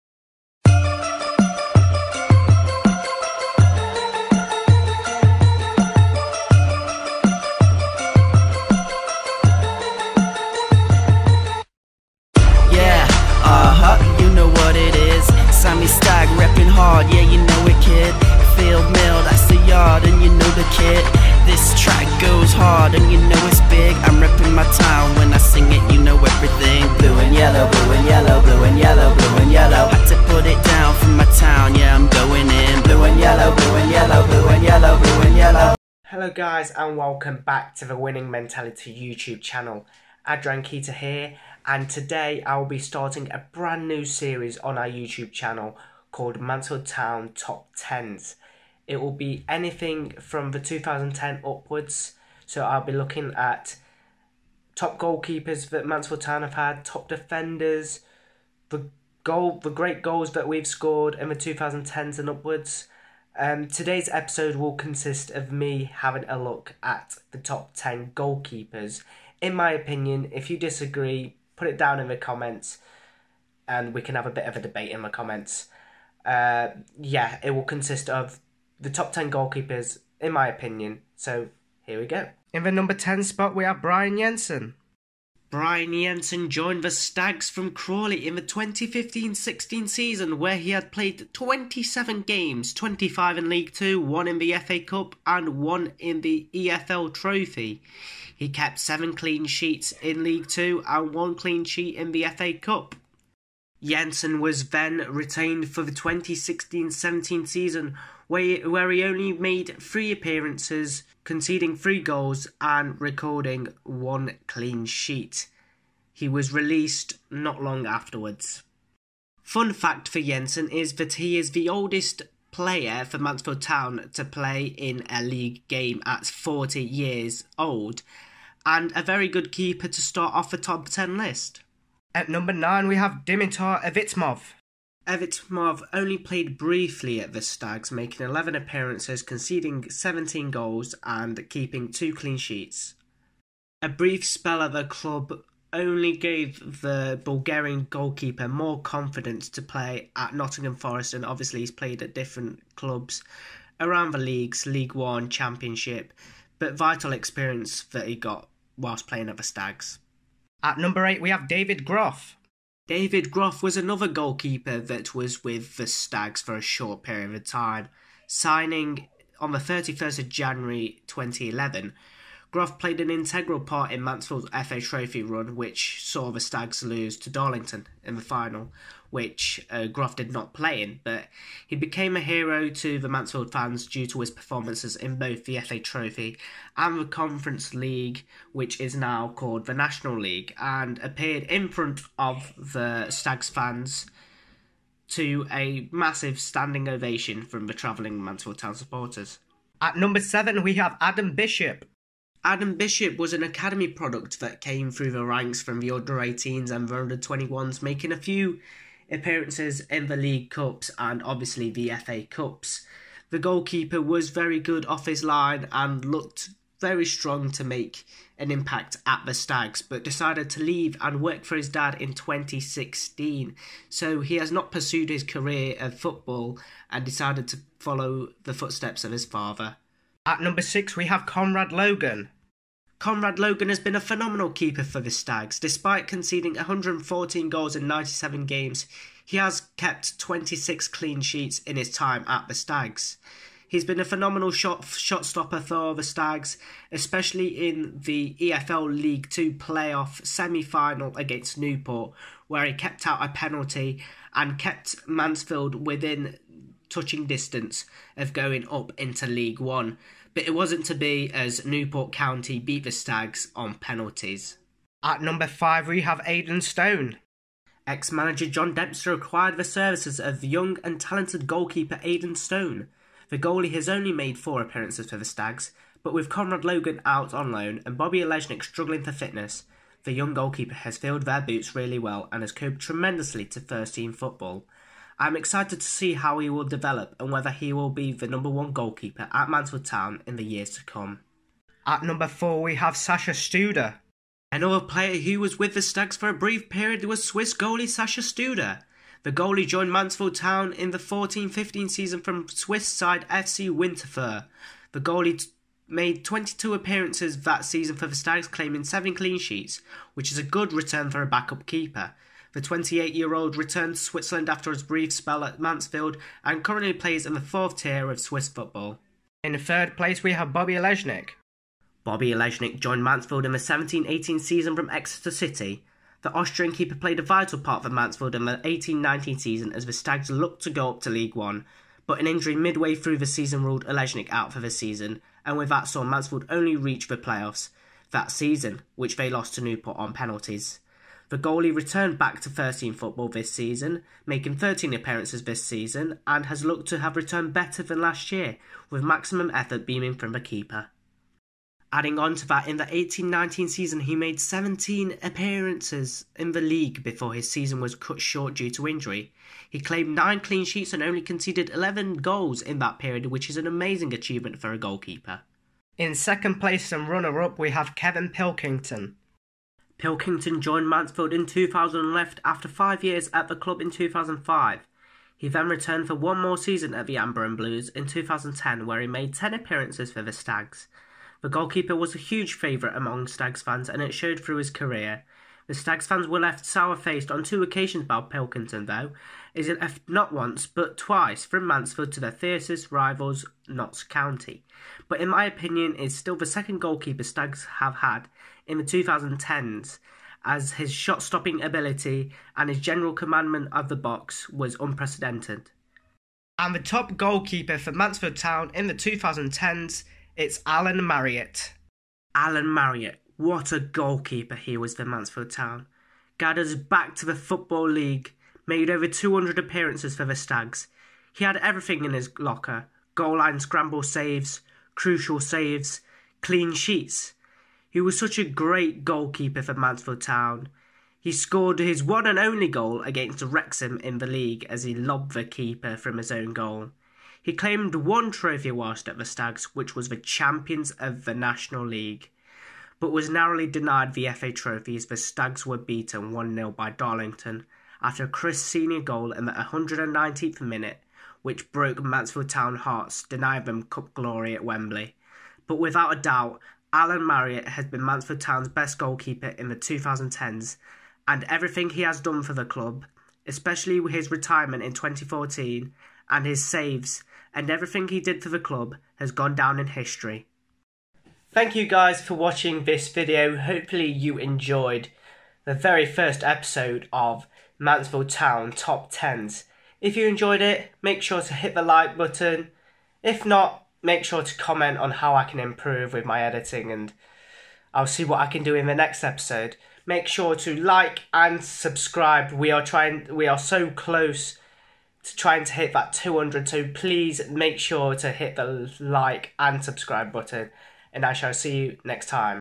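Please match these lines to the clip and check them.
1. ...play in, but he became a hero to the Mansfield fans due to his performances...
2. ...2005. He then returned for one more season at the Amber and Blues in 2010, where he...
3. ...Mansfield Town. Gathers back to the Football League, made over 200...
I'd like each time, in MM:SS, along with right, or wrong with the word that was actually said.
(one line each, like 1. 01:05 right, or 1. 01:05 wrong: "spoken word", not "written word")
1. 03:00 right
2. 06:13 right
3. 06:55 right.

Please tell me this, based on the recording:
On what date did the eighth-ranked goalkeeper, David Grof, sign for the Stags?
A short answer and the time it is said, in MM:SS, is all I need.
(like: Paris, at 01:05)
31st of January 2011, at 02:49.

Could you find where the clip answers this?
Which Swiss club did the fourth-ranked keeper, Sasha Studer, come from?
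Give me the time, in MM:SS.
05:03.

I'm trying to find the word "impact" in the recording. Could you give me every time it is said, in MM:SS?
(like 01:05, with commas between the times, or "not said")
03:38.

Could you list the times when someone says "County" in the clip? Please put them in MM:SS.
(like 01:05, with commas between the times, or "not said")
04:22, 06:34.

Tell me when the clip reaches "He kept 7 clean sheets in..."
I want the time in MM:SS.
01:38.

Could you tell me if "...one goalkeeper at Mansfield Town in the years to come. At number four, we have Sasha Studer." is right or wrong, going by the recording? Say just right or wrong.
right.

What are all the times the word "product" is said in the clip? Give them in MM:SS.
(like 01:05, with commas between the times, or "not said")
03:23.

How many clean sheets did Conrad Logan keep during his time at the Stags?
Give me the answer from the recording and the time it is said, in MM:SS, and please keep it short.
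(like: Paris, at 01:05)
26, at 04:00.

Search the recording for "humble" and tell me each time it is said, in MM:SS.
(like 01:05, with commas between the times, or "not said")
not said.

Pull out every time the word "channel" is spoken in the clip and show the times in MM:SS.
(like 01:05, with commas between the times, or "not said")
00:39, 00:45.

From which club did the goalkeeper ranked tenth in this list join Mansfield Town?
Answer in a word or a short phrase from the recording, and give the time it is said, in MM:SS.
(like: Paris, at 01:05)
Crawley, at 01:27.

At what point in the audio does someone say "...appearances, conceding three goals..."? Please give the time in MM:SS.
01:50.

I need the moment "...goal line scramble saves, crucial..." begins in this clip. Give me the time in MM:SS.
07:03.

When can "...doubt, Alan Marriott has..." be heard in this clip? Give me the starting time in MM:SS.
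07:36.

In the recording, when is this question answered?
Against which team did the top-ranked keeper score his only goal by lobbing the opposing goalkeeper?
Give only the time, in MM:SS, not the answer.
07:13.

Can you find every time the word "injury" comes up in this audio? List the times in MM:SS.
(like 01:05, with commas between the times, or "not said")
05:32, 05:58.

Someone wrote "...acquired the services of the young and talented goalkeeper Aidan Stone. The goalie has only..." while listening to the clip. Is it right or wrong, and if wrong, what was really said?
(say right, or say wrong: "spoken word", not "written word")
right.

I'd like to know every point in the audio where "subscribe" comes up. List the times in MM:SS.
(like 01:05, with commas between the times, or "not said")
08:11, 08:19.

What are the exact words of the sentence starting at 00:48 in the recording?
It will be anything from the 2010 upwards.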